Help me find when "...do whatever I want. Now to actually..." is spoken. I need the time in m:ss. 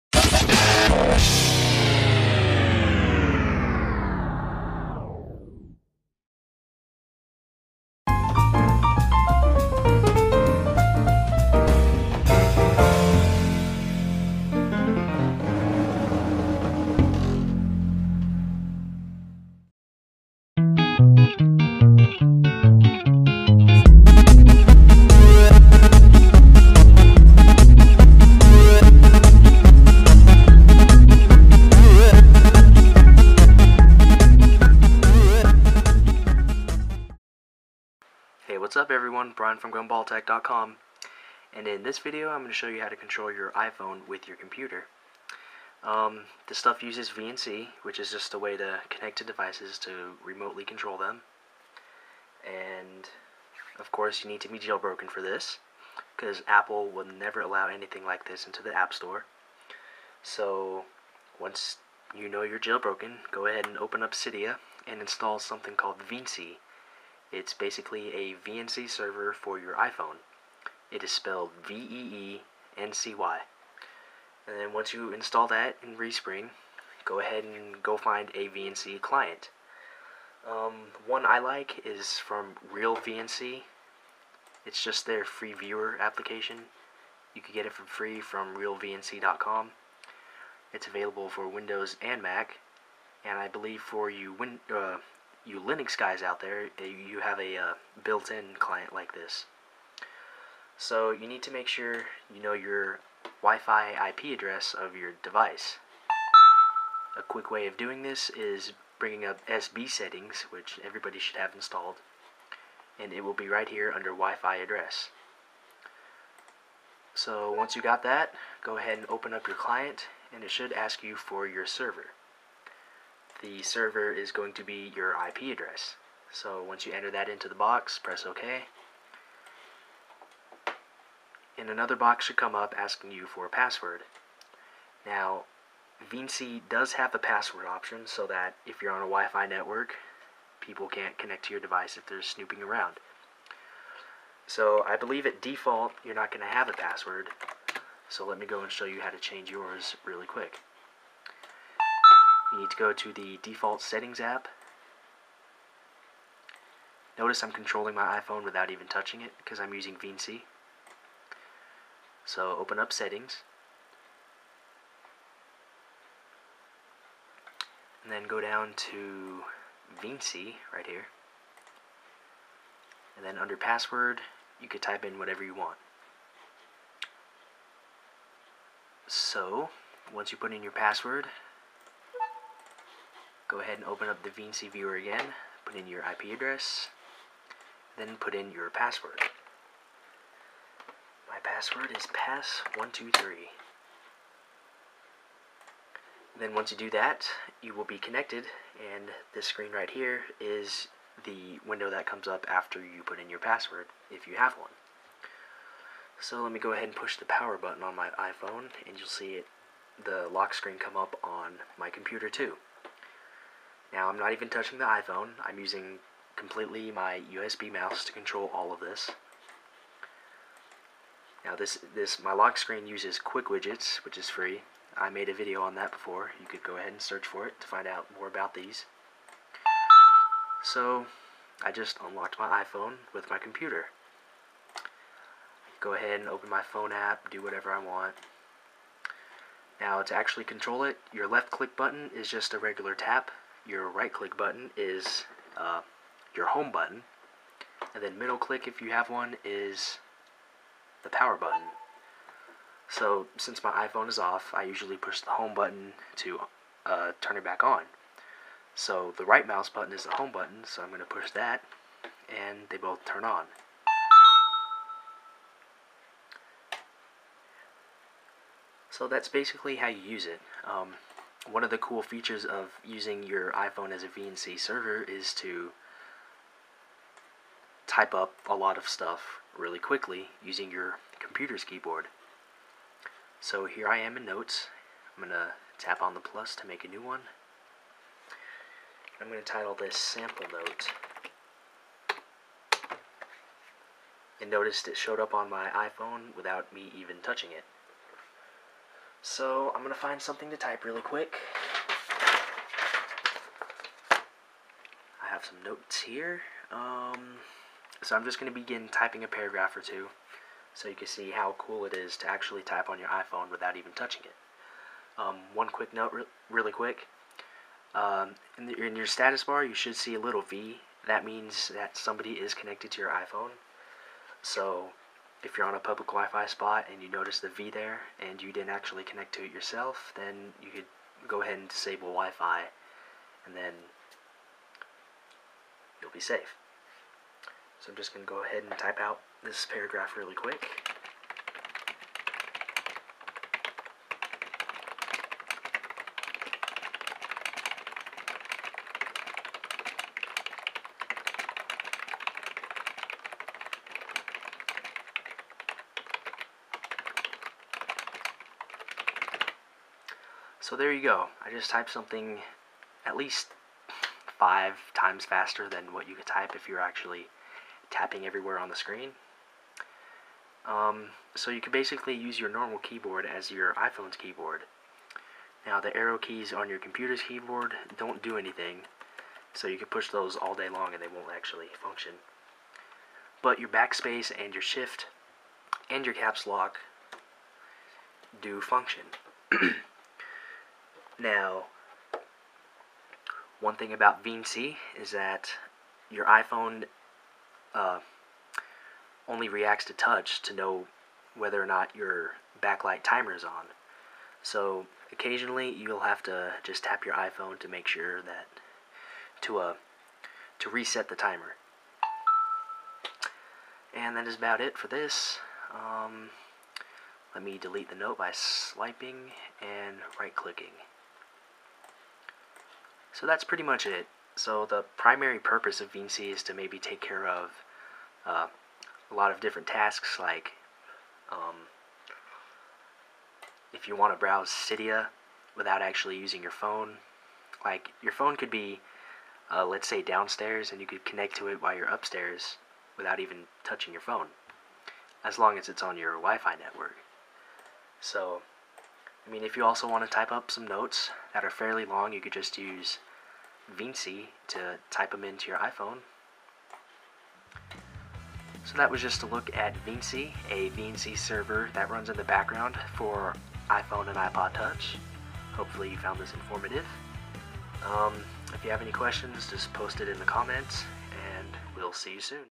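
3:57.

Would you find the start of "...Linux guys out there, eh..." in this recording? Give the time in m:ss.
1:35.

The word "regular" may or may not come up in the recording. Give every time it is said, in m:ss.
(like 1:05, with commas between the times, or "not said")
4:02.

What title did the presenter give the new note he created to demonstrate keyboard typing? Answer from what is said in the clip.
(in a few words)
Sample Note.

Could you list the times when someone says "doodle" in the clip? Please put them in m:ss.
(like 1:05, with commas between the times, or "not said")
not said.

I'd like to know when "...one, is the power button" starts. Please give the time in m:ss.
4:09.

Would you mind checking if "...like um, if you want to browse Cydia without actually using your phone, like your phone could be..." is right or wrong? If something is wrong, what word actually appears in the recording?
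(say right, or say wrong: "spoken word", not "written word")
right.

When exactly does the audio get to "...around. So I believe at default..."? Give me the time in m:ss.
2:22.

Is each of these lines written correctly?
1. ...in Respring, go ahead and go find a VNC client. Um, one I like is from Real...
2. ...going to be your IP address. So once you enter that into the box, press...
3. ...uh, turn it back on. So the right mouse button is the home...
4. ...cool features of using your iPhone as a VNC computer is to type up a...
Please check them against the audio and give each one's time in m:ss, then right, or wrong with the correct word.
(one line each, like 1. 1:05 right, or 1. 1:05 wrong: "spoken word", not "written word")
1. 1:15 right
2. 2:04 right
3. 4:16 right
4. 4:31 wrong: "server", not "computer".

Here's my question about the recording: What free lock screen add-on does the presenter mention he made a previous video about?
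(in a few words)
Quick Widgets.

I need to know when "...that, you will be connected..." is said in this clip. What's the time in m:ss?
3:16.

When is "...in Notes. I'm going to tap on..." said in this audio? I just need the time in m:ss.
4:44.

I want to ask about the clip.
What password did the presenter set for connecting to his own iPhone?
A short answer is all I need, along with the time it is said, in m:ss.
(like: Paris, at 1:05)
pass123, at 3:12.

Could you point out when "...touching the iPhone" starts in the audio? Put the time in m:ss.
3:34.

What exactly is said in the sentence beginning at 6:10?
Um, so you can basically use your normal keyboard as your iPhone's keyboard.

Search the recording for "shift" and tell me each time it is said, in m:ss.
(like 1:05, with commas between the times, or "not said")
6:24.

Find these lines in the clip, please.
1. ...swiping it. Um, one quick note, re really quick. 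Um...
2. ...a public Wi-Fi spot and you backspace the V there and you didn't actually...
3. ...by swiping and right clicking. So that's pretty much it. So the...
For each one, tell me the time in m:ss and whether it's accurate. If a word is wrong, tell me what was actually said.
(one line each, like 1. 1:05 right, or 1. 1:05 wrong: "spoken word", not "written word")
1. 5:13 wrong: "touching", not "swiping"
2. 5:25 wrong: "notice", not "backspace"
3. 6:58 right.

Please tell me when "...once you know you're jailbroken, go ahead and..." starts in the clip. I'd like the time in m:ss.
1:01.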